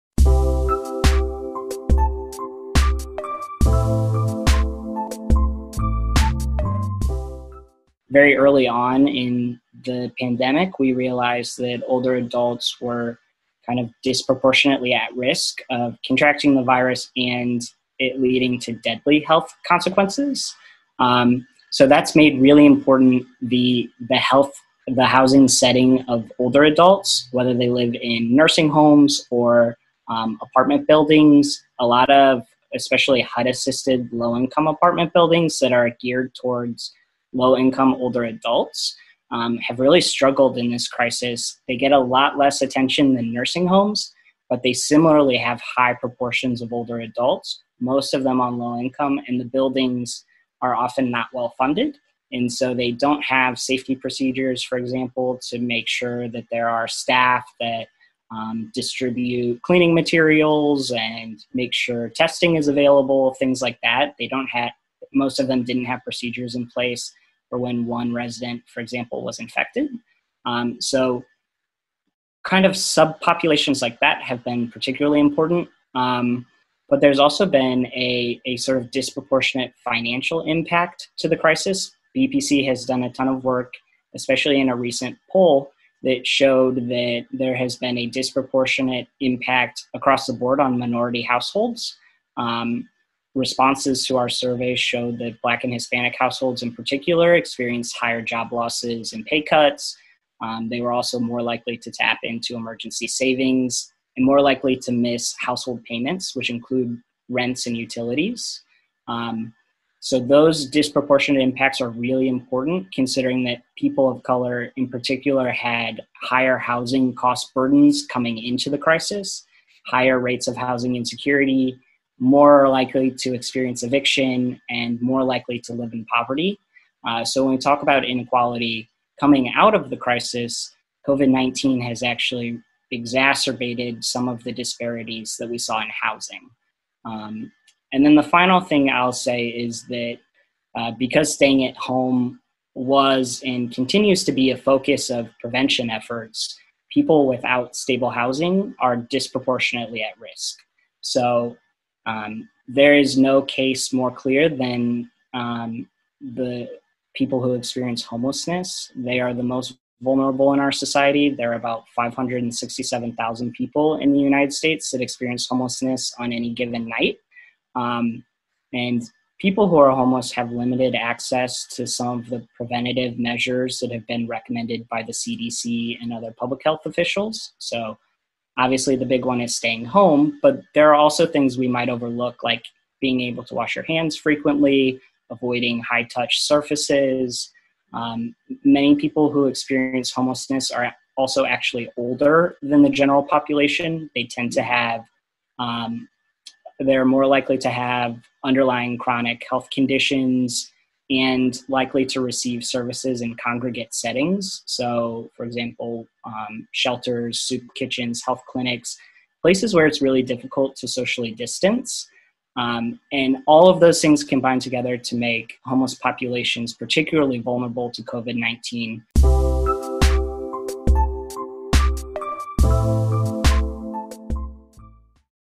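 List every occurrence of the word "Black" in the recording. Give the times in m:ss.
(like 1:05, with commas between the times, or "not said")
1:35.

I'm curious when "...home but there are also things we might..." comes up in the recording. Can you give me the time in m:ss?
2:59.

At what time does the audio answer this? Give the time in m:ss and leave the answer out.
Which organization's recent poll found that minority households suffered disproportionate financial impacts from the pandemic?
1:22.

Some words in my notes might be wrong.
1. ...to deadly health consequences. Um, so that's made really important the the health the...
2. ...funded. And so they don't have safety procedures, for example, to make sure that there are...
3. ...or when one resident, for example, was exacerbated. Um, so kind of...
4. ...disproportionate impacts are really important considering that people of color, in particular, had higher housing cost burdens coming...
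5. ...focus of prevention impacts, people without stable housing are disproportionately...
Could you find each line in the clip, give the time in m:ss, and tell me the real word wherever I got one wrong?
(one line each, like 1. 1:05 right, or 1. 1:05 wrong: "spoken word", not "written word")
1. 0:18 right
2. 0:51 right
3. 1:07 wrong: "infected", not "exacerbated"
4. 1:50 right
5. 2:24 wrong: "efforts", not "impacts".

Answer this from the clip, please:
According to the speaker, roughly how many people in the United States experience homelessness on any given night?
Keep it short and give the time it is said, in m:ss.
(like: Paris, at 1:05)
567,000, at 2:41.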